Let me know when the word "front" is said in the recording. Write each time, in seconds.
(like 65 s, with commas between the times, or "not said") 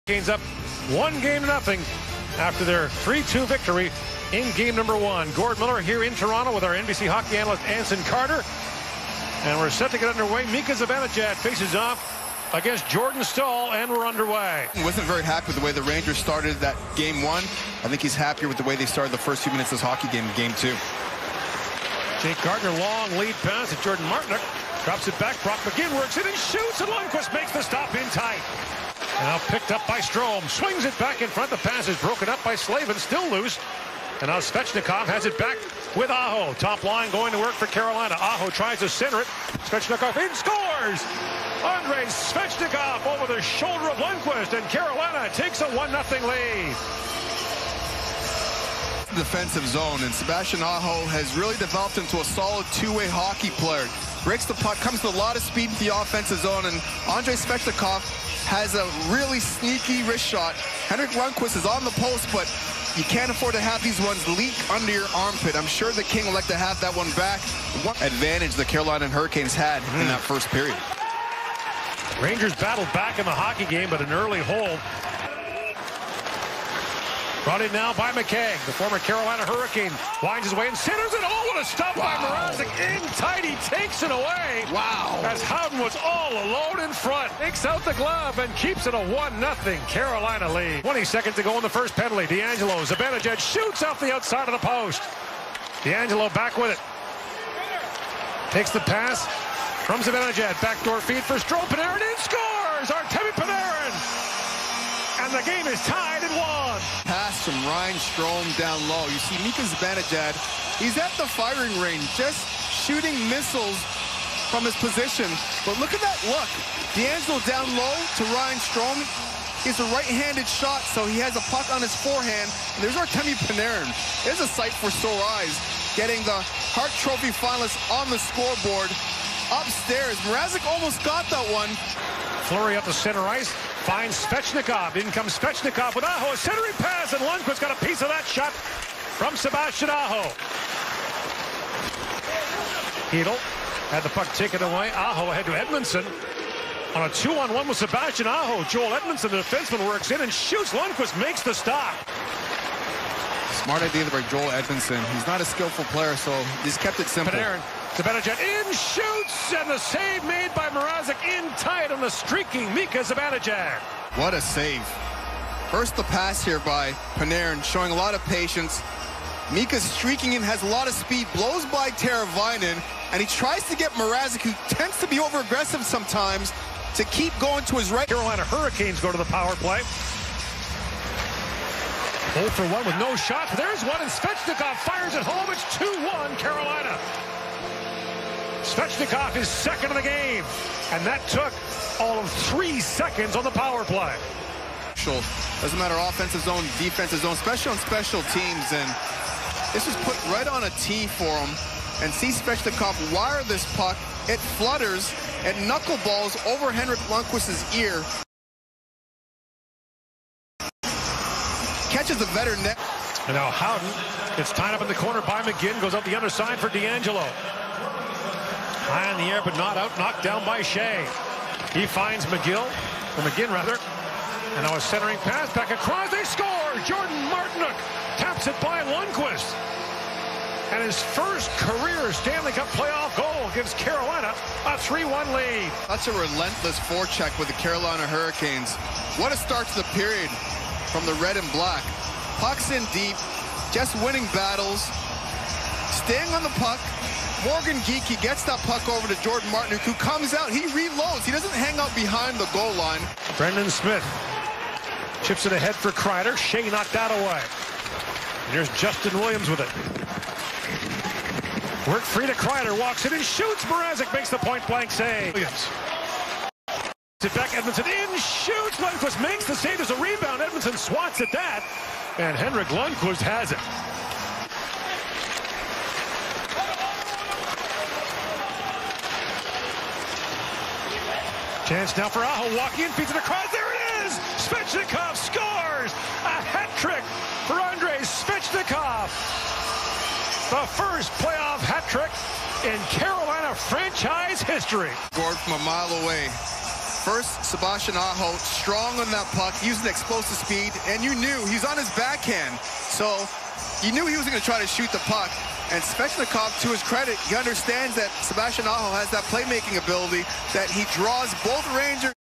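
31 s, 86 s.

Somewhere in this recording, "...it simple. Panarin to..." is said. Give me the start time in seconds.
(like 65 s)
156 s.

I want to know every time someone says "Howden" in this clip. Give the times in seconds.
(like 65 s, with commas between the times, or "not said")
85 s, 213 s.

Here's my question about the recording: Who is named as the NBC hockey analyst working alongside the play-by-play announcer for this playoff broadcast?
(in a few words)
Anson Carter.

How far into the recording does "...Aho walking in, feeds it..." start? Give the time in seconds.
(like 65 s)
282 s.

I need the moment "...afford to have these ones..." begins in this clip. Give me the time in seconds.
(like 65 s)
63 s.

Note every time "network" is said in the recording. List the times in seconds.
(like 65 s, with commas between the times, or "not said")
not said.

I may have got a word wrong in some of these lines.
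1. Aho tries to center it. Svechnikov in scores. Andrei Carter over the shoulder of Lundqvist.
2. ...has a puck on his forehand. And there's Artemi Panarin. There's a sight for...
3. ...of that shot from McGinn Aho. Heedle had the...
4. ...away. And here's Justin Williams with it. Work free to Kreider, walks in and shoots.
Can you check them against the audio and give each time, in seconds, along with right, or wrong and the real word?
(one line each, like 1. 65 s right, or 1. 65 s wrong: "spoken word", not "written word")
1. 38 s wrong: "Svechnikov", not "Carter"
2. 121 s right
3. 138 s wrong: "Sebastian", not "McGinn"
4. 257 s right.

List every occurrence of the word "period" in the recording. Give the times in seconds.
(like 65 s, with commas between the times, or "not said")
70 s, 239 s.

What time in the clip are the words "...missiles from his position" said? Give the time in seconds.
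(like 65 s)
113 s.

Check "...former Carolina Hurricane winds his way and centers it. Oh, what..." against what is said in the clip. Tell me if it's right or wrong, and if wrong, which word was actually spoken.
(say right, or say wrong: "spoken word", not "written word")
right.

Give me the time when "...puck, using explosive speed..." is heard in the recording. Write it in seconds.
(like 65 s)
299 s.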